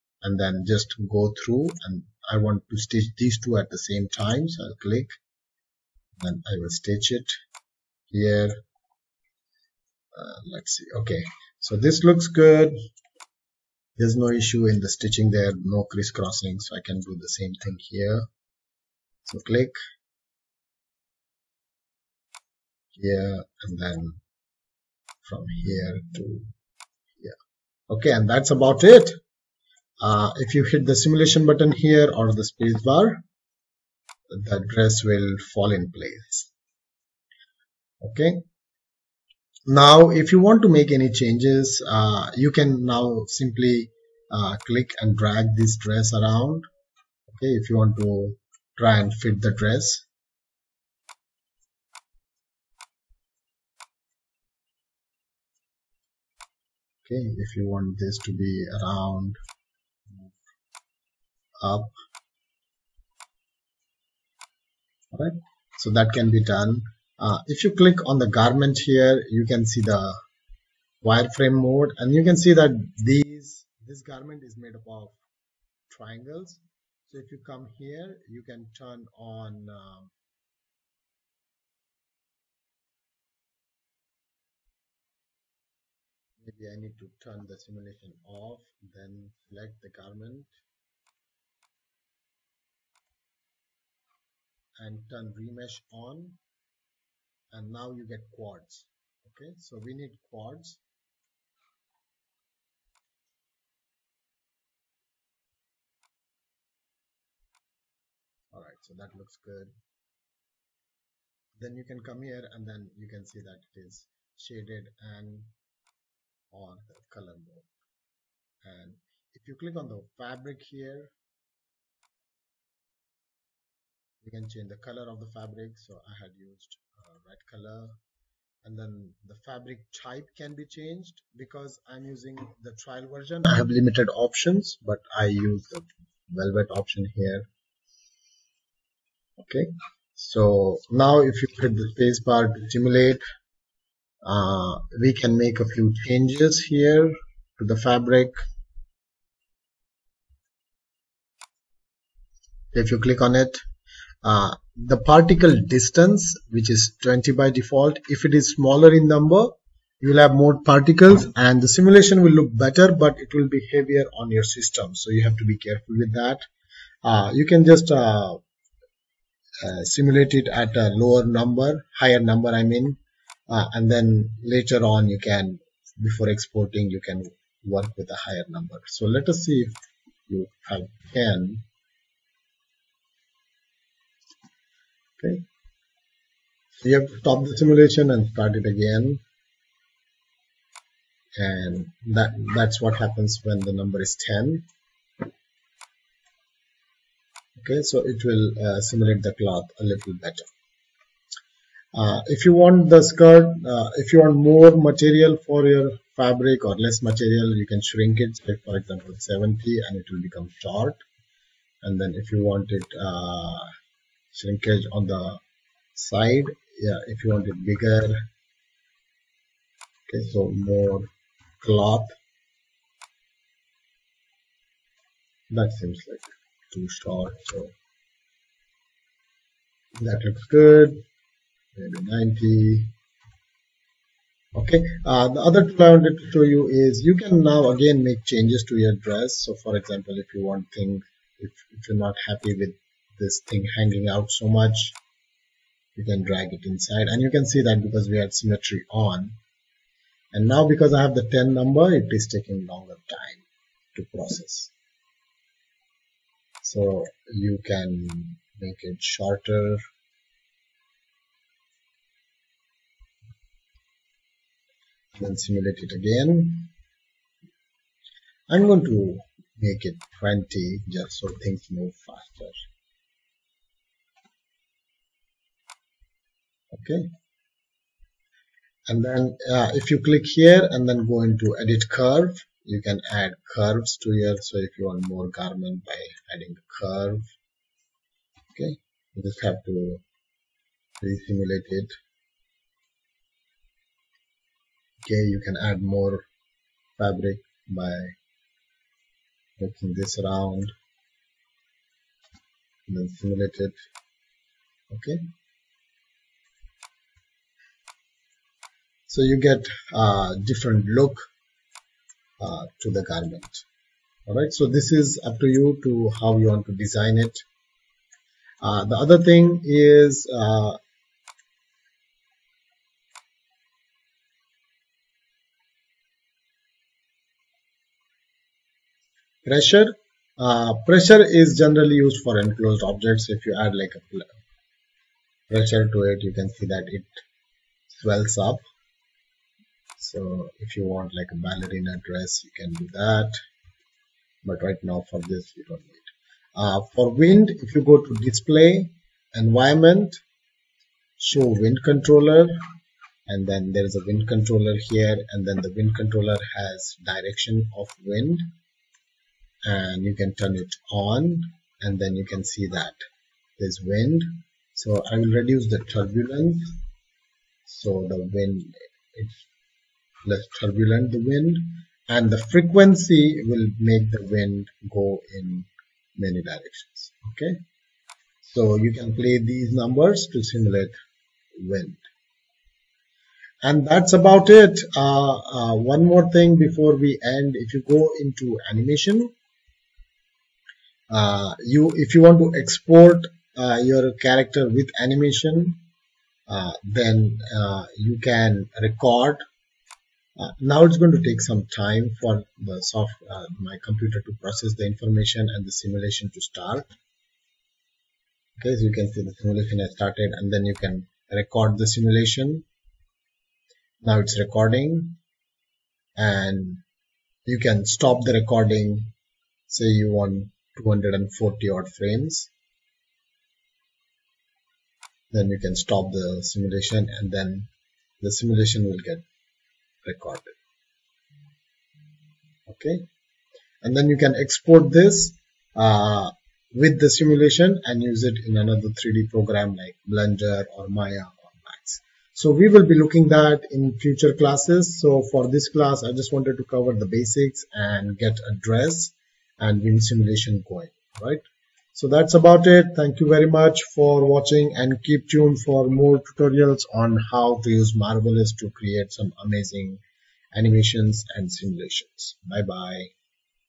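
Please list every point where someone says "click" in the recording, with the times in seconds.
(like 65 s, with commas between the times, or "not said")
4 s, 19 s, 44 s, 67 s, 119 s, 152 s, 280 s.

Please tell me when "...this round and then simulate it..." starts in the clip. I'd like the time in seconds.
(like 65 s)
299 s.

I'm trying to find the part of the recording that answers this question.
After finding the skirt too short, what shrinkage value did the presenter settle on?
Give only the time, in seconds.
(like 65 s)
232 s.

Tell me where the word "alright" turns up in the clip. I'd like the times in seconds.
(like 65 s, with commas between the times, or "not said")
108 s, 314 s.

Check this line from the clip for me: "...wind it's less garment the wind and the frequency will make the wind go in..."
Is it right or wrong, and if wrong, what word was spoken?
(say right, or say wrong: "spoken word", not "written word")
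wrong: "turbulent", not "garment".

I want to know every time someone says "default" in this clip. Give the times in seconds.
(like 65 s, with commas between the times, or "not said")
157 s.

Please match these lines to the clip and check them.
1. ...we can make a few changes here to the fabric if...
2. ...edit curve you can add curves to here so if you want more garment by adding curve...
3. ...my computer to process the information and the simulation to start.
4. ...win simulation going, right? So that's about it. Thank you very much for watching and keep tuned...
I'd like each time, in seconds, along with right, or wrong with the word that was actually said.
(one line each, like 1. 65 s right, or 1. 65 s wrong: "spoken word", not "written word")
1. 145 s right
2. 281 s right
3. 403 s right
4. 449 s right.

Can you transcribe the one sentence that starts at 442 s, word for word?
So we will be looking that in future classes.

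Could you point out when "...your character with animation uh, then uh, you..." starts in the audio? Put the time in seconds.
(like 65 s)
393 s.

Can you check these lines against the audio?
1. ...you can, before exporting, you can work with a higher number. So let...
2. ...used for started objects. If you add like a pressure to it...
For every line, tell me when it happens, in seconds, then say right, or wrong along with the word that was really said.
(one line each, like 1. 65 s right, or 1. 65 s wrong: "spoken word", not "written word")
1. 175 s right
2. 332 s wrong: "enclosed", not "started".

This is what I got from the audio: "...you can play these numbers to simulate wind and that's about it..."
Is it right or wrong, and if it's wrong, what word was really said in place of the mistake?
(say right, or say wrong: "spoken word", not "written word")
right.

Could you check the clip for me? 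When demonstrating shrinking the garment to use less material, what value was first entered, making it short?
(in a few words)
70.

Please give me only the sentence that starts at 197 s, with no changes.
Okay, so it will uh, simulate the cloth a little better.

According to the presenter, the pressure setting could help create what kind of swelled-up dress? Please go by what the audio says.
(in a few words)
Ballerina dress.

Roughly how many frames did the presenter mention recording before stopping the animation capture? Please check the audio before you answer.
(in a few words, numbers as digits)
240.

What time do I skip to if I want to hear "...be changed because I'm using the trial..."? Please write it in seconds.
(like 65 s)
130 s.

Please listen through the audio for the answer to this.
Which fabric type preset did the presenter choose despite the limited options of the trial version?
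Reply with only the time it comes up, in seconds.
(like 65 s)
136 s.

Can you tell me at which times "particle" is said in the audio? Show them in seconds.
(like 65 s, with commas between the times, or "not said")
154 s, 160 s.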